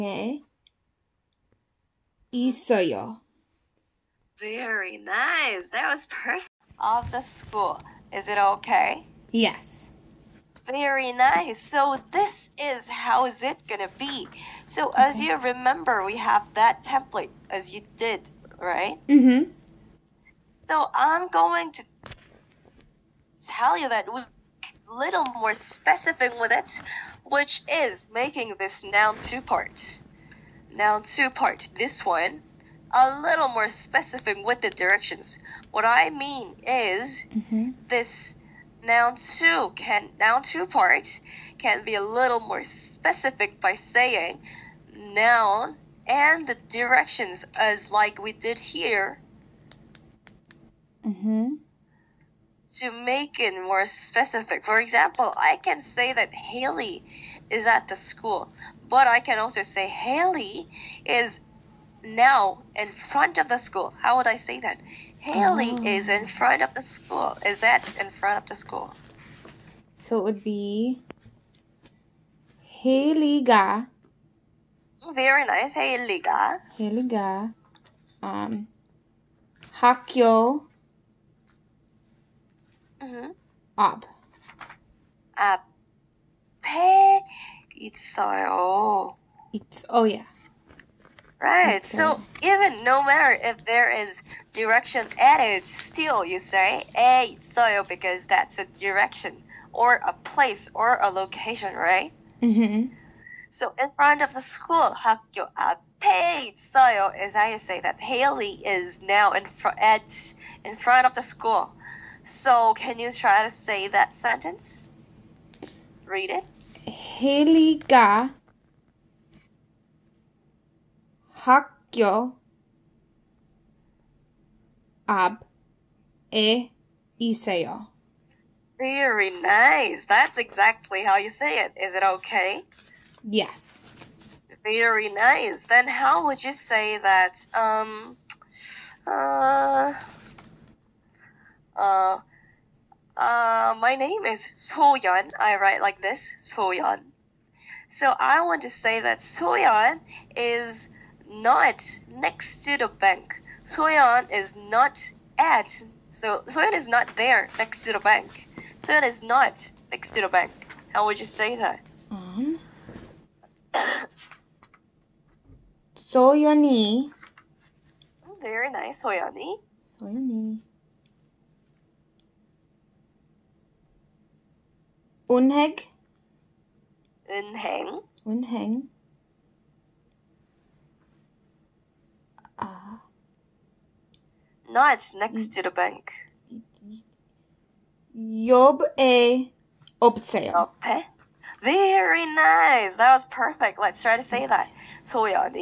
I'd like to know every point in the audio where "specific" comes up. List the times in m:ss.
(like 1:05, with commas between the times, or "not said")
0:25, 0:33, 0:42, 0:53.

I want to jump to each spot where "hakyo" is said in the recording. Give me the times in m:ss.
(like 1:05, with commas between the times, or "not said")
1:19, 2:01.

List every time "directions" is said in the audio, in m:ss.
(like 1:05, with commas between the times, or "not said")
0:34, 0:46, 1:34, 1:38.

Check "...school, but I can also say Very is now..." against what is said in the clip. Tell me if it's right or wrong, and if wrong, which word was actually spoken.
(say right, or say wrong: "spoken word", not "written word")
wrong: "Hayley", not "Very".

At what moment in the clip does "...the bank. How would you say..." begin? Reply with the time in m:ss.
2:40.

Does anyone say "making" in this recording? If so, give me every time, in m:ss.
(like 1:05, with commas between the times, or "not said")
0:28.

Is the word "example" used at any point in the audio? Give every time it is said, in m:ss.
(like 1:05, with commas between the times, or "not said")
0:54.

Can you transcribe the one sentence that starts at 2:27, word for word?
So I want to say that Soyeon is not next to the bank.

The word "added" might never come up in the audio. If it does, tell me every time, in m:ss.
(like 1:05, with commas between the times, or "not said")
1:35.